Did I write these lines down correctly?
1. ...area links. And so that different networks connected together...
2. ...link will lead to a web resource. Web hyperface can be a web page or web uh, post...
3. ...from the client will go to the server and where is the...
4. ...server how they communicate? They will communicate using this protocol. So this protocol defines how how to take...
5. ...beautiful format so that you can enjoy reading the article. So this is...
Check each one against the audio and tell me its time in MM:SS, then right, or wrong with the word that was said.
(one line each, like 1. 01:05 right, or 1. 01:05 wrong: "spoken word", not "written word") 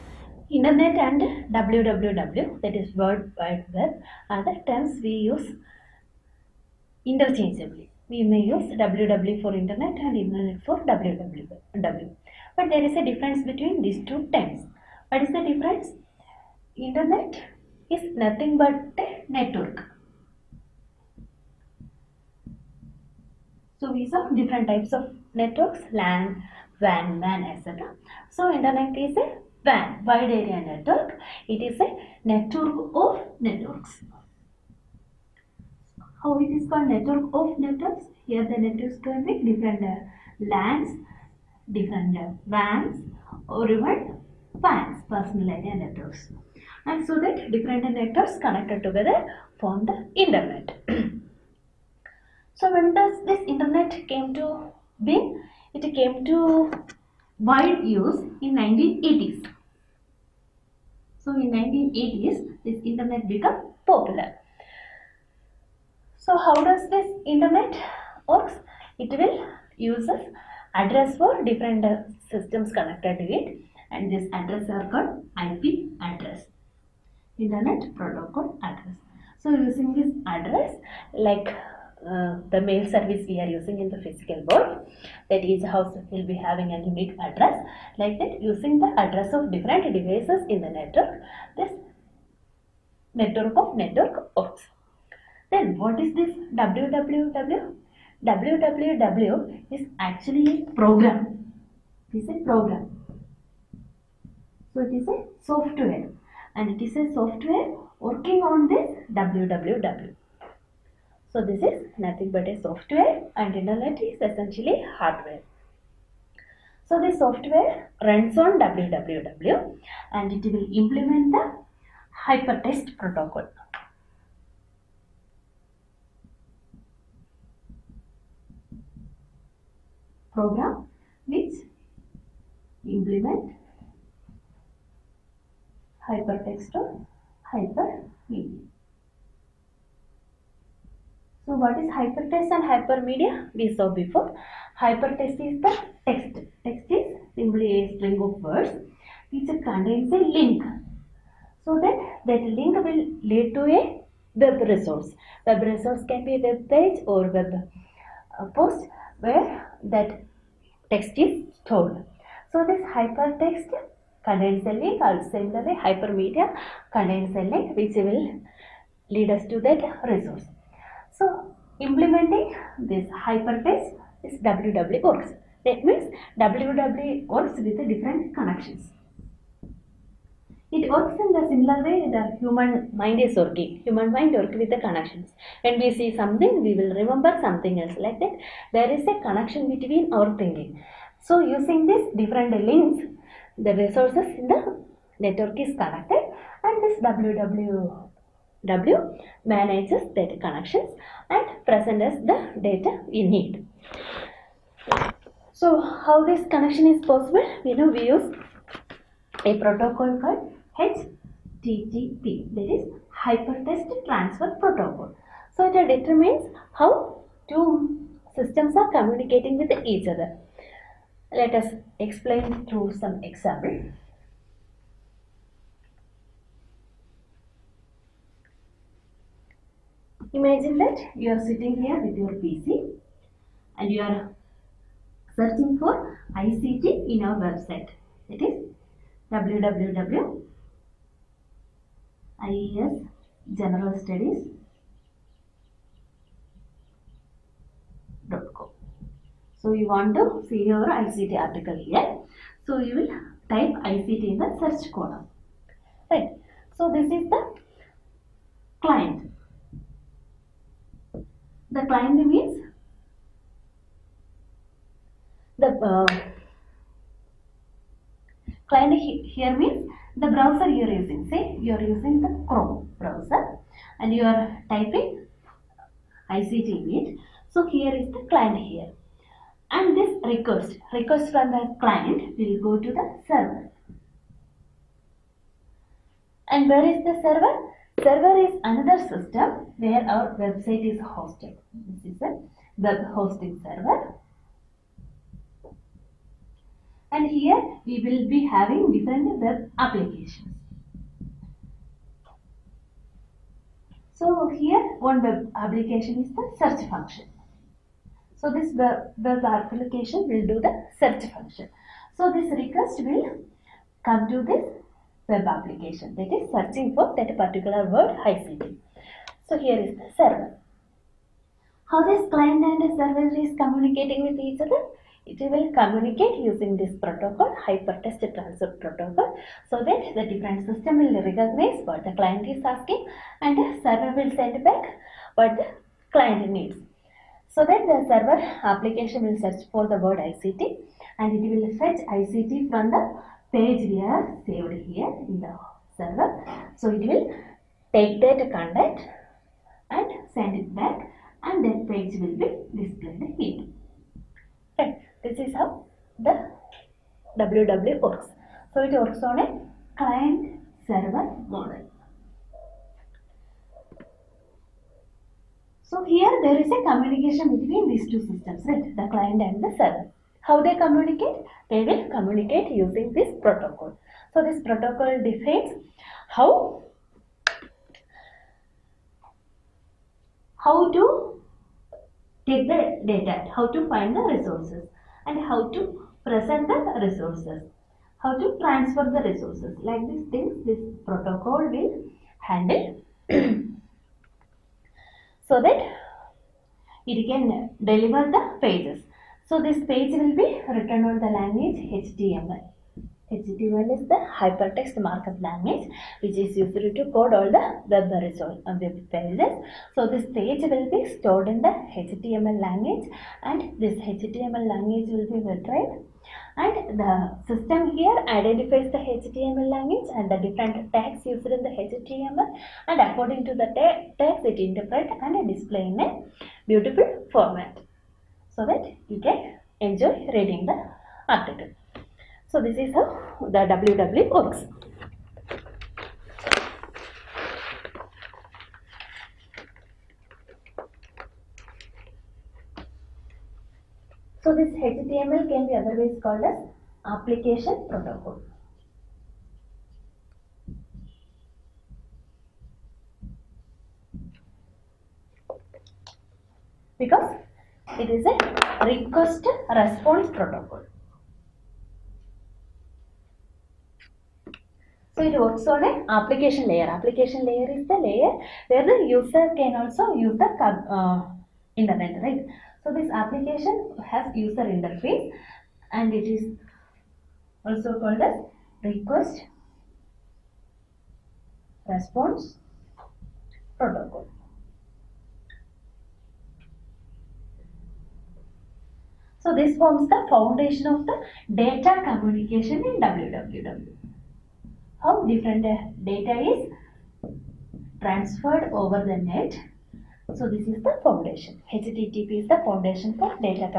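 1. 00:45 wrong: "networks", not "links"
2. 02:32 wrong: "resource", not "hyperface"
3. 04:41 right
4. 06:09 right
5. 07:06 right.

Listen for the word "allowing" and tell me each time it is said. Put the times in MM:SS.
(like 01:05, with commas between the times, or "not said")
not said.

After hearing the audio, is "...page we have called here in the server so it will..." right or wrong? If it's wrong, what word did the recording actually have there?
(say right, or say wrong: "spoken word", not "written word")
wrong: "saved", not "called".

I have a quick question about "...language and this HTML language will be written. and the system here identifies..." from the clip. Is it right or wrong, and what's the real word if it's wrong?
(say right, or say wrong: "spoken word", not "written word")
right.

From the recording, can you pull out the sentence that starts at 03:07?
Like that, there is a connection between our thinking.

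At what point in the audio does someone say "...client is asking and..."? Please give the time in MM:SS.
05:32.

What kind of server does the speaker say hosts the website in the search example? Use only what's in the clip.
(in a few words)
web hosting server.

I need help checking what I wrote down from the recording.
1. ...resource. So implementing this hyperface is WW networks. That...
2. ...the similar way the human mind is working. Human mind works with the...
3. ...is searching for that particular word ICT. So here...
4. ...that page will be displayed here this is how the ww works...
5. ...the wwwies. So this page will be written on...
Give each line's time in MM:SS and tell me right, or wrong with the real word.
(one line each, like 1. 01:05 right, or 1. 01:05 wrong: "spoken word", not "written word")
1. 02:50 wrong: "works", not "networks"
2. 03:01 right
3. 05:16 right
4. 05:51 right
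5. 06:38 wrong: "pages", not "wwwies".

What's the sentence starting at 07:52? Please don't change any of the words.
So this application has user interface and it is also called as request response protocol.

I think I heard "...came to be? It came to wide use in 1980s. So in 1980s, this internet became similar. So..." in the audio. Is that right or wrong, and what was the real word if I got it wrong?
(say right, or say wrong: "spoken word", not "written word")
wrong: "popular", not "similar".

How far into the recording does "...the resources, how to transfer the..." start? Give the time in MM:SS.
06:26.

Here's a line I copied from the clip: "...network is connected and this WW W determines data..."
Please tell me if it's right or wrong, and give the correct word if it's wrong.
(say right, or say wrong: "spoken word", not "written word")
wrong: "manages", not "determines".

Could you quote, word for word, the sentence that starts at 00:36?
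How it is called network of networks?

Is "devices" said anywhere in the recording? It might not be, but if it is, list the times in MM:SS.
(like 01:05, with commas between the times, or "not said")
01:29.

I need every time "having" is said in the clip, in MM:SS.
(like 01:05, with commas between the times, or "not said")
01:26, 04:58.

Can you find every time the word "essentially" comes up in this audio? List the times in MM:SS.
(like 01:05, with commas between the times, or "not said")
01:54.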